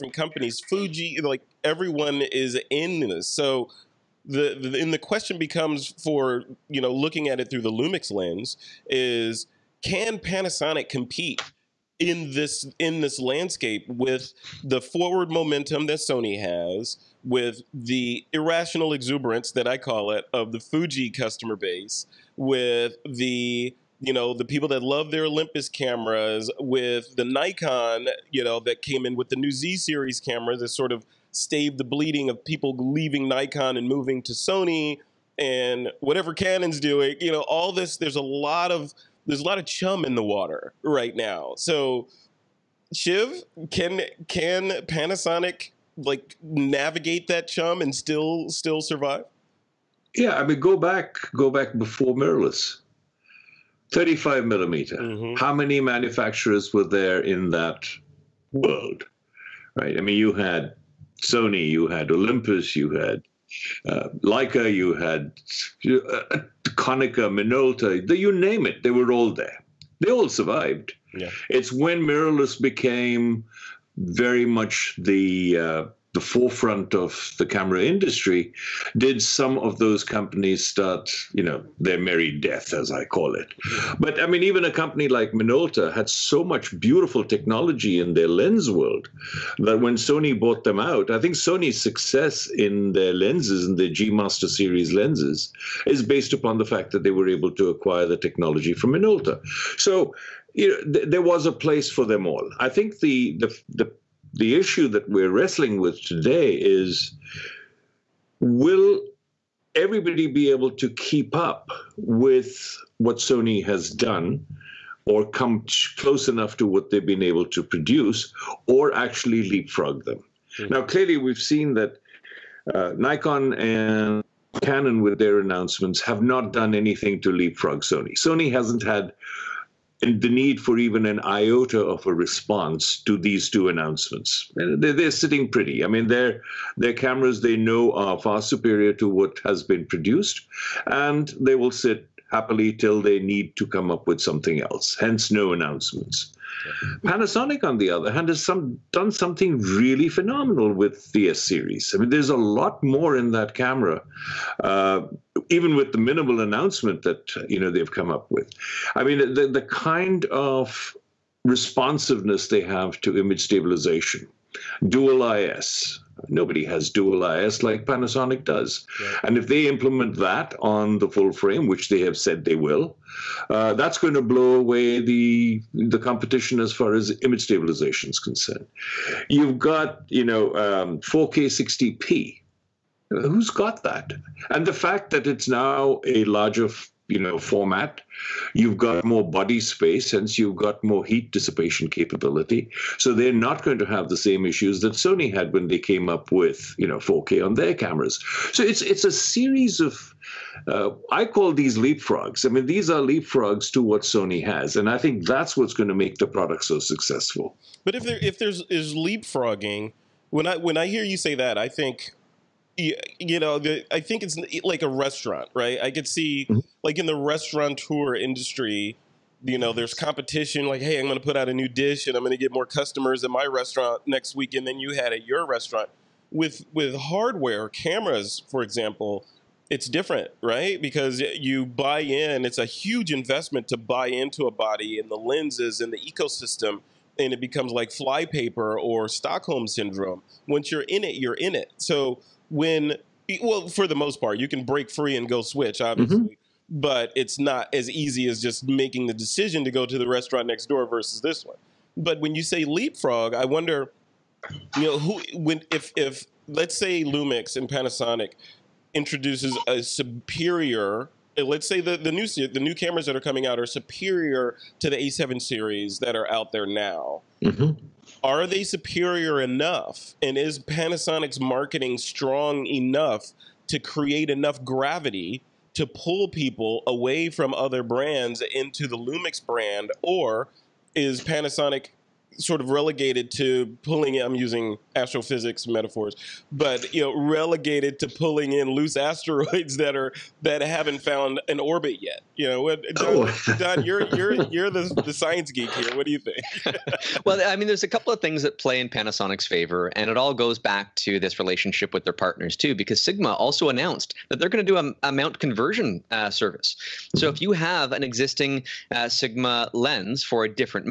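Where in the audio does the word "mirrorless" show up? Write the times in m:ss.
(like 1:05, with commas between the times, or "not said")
0:52, 1:12.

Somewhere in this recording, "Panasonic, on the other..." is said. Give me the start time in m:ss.
2:27.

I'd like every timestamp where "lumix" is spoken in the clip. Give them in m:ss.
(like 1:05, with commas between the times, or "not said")
0:07, 4:17, 4:38.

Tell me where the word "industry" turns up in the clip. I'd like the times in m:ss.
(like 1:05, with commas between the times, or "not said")
1:17, 3:38.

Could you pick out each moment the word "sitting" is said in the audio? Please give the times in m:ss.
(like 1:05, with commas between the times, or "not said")
2:15.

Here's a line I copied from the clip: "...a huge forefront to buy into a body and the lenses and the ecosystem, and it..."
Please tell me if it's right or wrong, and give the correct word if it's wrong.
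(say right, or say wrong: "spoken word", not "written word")
wrong: "investment", not "forefront".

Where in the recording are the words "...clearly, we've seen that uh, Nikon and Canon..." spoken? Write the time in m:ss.
2:00.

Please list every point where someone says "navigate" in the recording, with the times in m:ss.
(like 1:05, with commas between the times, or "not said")
0:46.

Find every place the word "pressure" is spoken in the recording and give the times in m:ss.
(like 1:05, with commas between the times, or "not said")
not said.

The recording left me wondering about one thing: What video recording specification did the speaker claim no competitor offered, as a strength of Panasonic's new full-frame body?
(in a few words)
4K 60p.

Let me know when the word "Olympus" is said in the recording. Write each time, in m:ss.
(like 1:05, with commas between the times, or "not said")
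0:25, 1:02.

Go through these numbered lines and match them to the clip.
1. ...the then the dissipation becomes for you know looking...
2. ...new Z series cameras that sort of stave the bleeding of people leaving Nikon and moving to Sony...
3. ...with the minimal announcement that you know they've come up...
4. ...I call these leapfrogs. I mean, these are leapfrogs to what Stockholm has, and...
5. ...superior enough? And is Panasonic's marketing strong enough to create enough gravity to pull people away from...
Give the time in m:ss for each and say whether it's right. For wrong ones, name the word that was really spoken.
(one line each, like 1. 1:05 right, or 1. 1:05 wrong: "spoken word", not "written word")
1. 0:04 wrong: "question", not "dissipation"
2. 0:29 right
3. 2:35 right
4. 3:21 wrong: "Sony", not "Stockholm"
5. 4:28 right.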